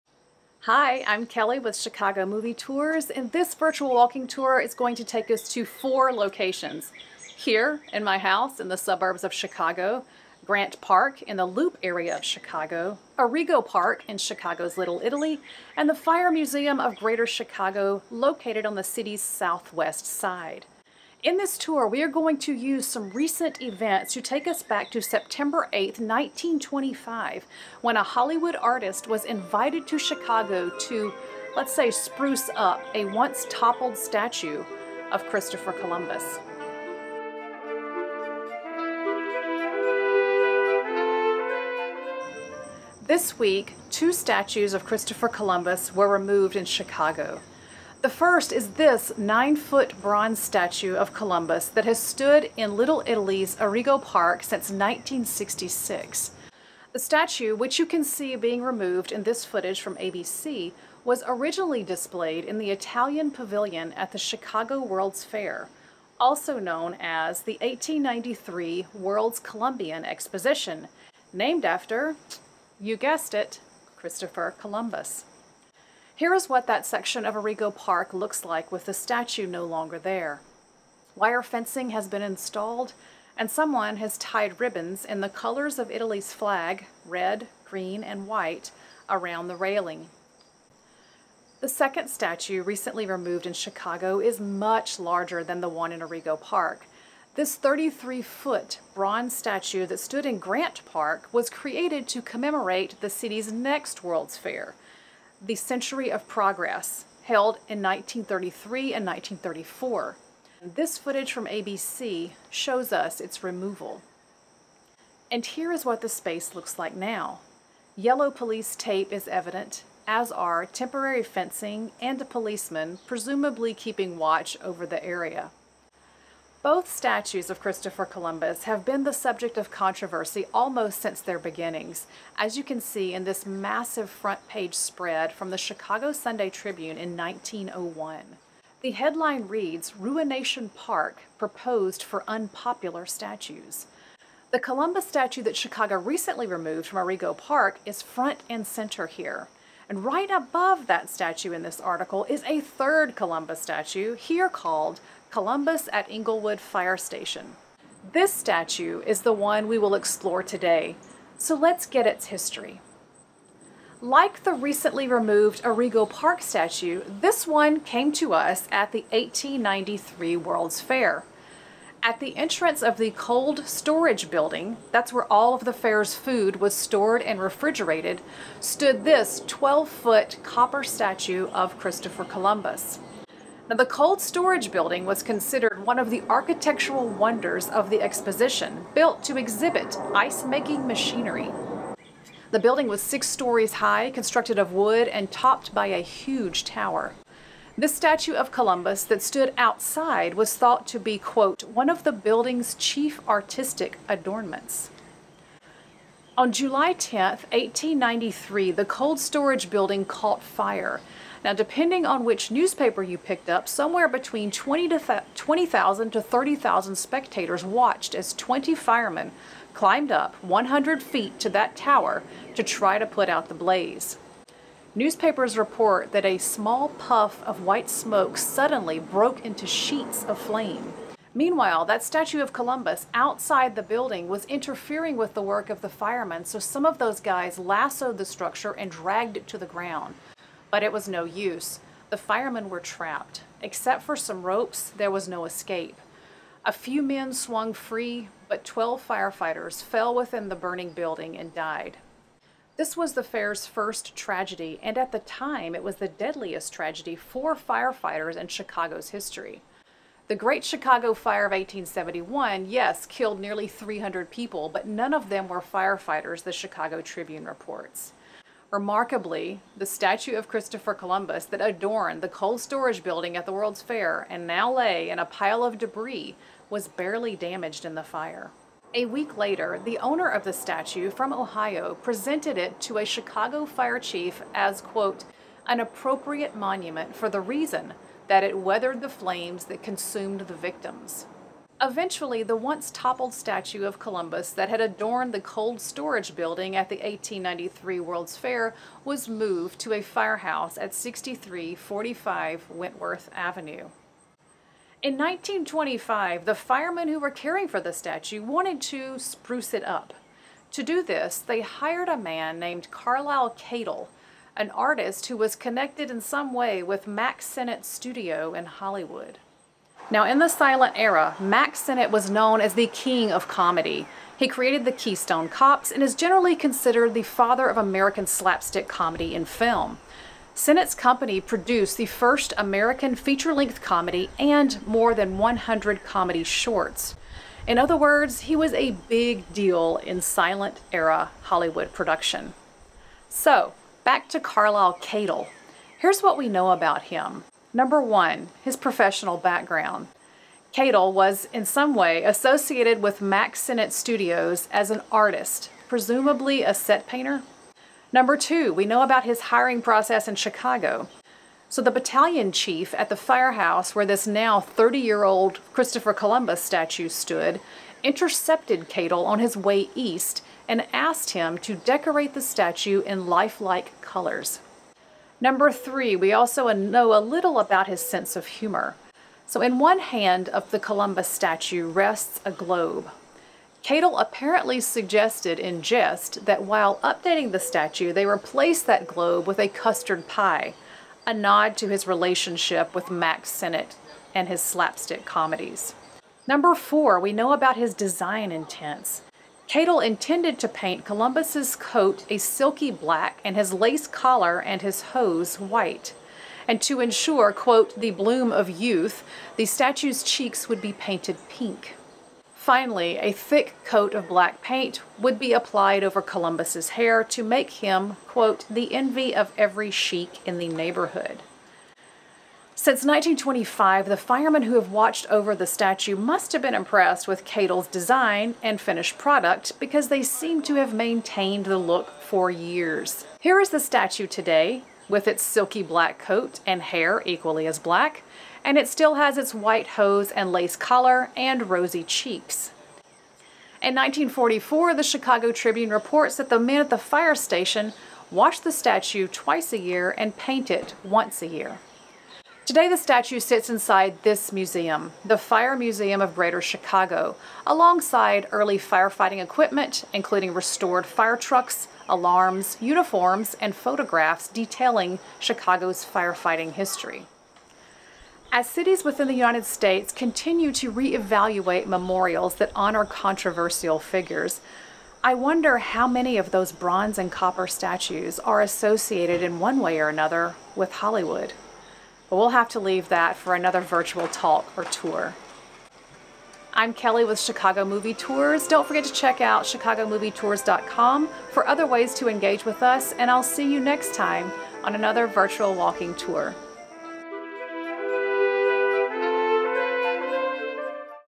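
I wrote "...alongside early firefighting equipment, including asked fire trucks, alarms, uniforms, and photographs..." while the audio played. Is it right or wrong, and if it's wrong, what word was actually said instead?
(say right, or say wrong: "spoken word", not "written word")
wrong: "restored", not "asked".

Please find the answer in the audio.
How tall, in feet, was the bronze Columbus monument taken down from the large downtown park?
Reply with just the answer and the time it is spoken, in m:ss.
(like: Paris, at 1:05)
33, at 1:37.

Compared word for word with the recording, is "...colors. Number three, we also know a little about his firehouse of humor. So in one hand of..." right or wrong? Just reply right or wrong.
wrong.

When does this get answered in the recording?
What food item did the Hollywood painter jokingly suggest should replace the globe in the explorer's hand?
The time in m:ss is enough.
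6:29.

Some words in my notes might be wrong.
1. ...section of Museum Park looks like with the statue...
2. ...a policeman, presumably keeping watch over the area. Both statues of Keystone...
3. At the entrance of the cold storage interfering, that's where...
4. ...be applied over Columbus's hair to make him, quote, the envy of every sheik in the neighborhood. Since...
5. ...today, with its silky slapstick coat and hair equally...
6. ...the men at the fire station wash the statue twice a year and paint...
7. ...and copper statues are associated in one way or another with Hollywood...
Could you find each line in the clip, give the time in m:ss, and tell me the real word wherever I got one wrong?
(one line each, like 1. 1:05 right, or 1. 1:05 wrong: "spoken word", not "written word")
1. 1:16 wrong: "Arrigo", not "Museum"
2. 2:02 wrong: "Christopher", not "Keystone"
3. 2:52 wrong: "building", not "interfering"
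4. 6:55 right
5. 7:14 wrong: "black", not "slapstick"
6. 7:26 right
7. 7:57 right.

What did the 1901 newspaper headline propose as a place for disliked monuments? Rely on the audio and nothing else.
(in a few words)
Ruination Park.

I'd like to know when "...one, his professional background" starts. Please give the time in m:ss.
5:48.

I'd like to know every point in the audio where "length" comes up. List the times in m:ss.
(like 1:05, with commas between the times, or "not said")
5:33.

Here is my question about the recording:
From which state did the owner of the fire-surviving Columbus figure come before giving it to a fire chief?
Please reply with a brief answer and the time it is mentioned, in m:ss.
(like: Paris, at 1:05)
Ohio, at 4:41.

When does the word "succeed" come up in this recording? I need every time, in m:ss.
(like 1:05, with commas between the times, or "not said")
not said.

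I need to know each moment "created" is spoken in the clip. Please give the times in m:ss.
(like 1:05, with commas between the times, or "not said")
1:41, 5:24.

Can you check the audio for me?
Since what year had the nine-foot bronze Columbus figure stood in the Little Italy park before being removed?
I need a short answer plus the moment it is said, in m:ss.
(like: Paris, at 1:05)
1966, at 0:54.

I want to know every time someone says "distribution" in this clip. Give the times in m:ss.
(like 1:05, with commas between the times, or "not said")
not said.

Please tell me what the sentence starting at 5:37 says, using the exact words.
In other words, he was a big deal in silent era Hollywood production.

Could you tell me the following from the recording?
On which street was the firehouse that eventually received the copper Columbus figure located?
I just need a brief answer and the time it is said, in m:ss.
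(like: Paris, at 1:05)
Wentworth Avenue, at 5:02.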